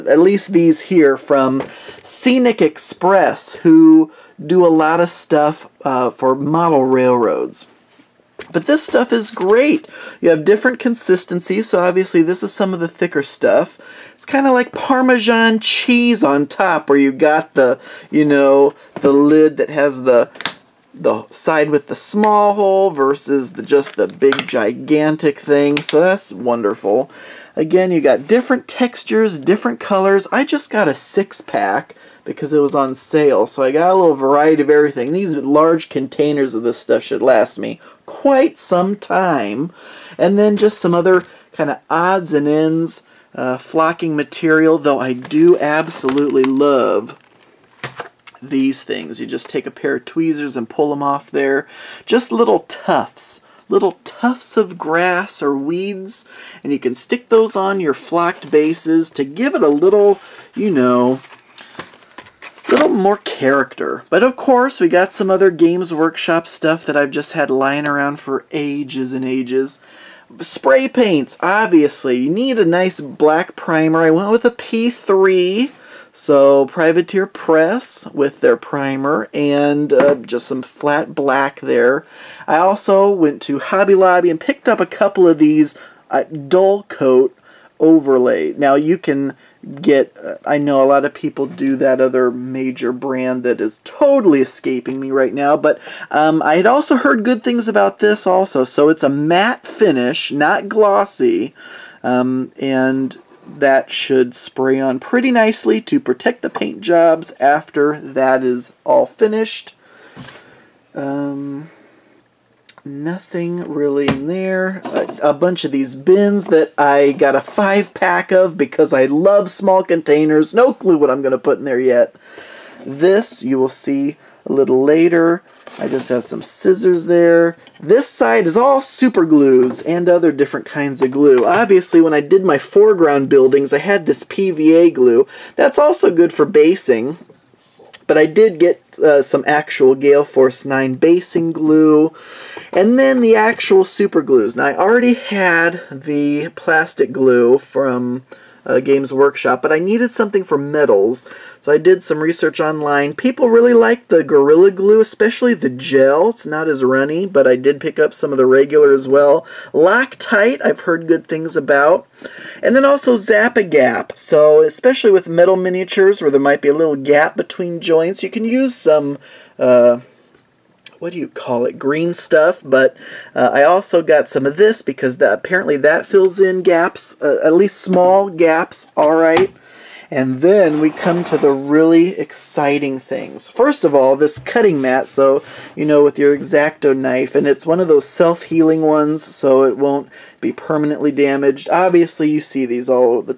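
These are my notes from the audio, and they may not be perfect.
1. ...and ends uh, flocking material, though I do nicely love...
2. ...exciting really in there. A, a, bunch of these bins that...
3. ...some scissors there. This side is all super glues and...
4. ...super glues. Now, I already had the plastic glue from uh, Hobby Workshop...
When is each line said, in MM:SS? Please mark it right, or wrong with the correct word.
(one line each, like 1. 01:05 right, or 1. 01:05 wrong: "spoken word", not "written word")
1. 00:42 wrong: "absolutely", not "nicely"
2. 01:52 wrong: "nothing", not "exciting"
3. 02:06 right
4. 02:23 wrong: "Games", not "Hobby".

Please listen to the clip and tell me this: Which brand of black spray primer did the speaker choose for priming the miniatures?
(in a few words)
P3.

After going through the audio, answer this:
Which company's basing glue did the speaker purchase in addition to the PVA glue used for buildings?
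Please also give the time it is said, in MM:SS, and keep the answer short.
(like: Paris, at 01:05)
Gale Force 9, at 02:19.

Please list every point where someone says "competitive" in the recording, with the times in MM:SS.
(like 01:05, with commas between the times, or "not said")
not said.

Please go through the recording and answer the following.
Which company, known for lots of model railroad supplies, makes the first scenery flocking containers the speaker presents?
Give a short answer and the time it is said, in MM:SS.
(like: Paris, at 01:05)
Scenic Express, at 00:02.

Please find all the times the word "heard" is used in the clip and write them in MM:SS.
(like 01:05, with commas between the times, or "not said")
01:36, 02:40.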